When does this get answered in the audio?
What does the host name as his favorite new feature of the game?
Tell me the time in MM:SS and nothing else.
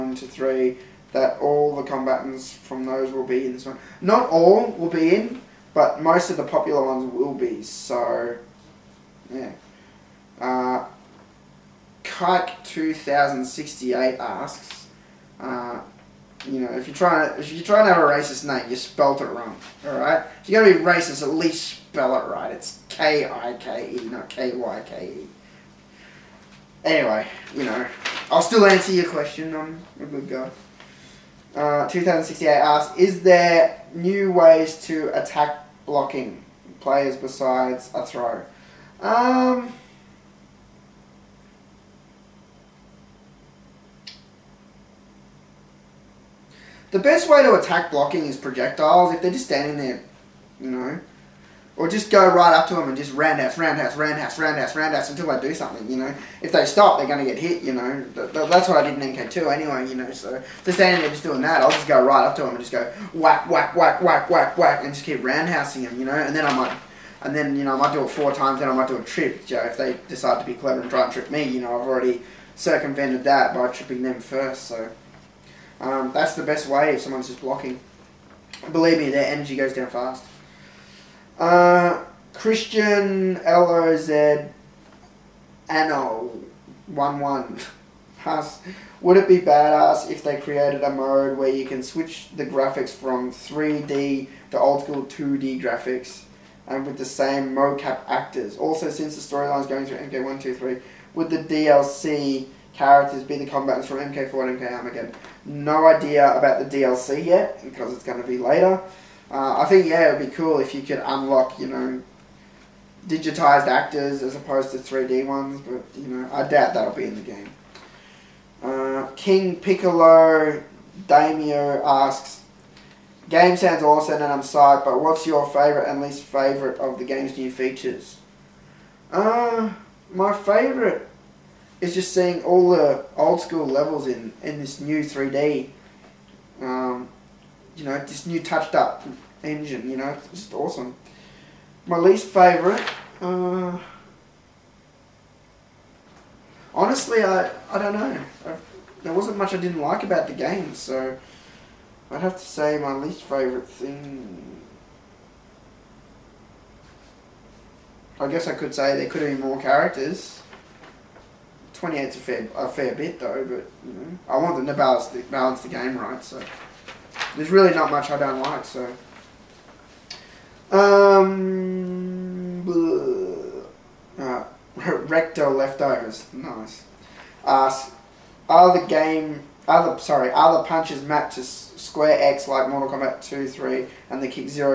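02:13.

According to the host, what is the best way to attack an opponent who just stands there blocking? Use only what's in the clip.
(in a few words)
Projectiles.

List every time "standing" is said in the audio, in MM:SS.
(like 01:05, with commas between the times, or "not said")
00:49, 01:00.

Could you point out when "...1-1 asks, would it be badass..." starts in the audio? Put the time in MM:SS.
01:26.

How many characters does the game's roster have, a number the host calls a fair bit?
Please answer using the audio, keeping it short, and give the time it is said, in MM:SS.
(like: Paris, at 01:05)
28, at 02:41.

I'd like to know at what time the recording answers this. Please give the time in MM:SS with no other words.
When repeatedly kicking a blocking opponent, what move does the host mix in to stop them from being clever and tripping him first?
01:08.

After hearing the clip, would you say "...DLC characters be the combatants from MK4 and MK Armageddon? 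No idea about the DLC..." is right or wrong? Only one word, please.
right.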